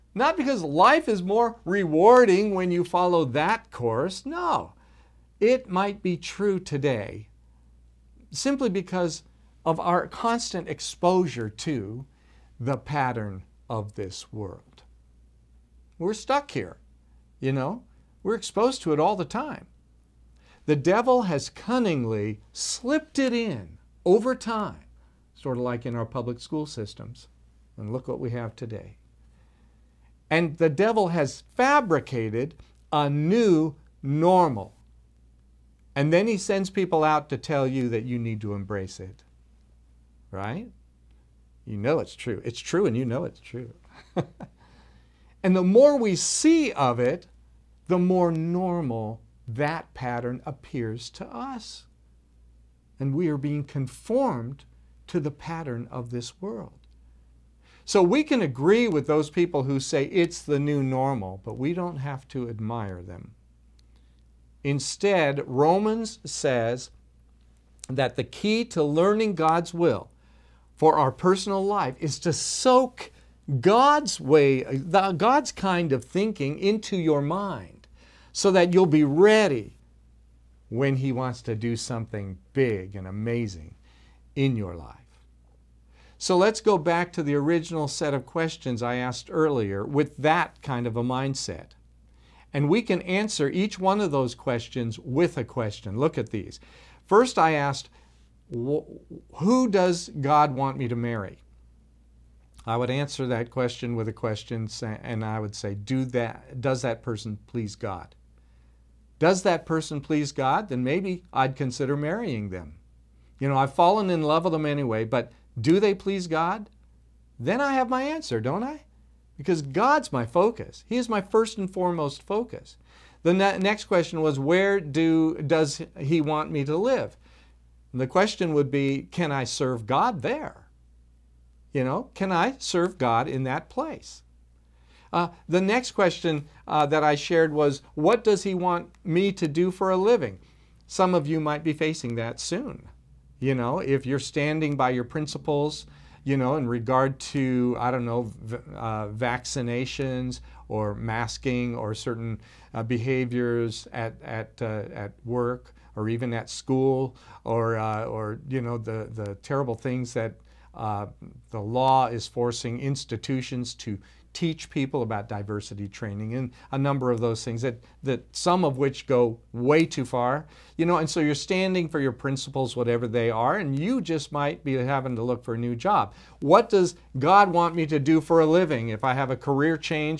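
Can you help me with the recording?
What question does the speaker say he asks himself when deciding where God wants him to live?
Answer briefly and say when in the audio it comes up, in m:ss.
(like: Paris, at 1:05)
Can I serve God there?, at 2:09.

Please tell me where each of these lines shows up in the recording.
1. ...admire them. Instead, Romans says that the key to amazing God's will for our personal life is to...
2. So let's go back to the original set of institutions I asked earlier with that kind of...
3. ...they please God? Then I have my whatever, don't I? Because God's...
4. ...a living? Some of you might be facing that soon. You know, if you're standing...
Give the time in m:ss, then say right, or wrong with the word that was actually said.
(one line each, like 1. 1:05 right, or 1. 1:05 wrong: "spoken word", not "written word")
1. 1:02 wrong: "learning", not "amazing"
2. 1:26 wrong: "questions", not "institutions"
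3. 1:55 wrong: "answer", not "whatever"
4. 2:19 right.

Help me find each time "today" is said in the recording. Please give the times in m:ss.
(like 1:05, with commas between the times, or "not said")
0:06, 0:28.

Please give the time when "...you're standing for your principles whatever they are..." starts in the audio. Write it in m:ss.
2:51.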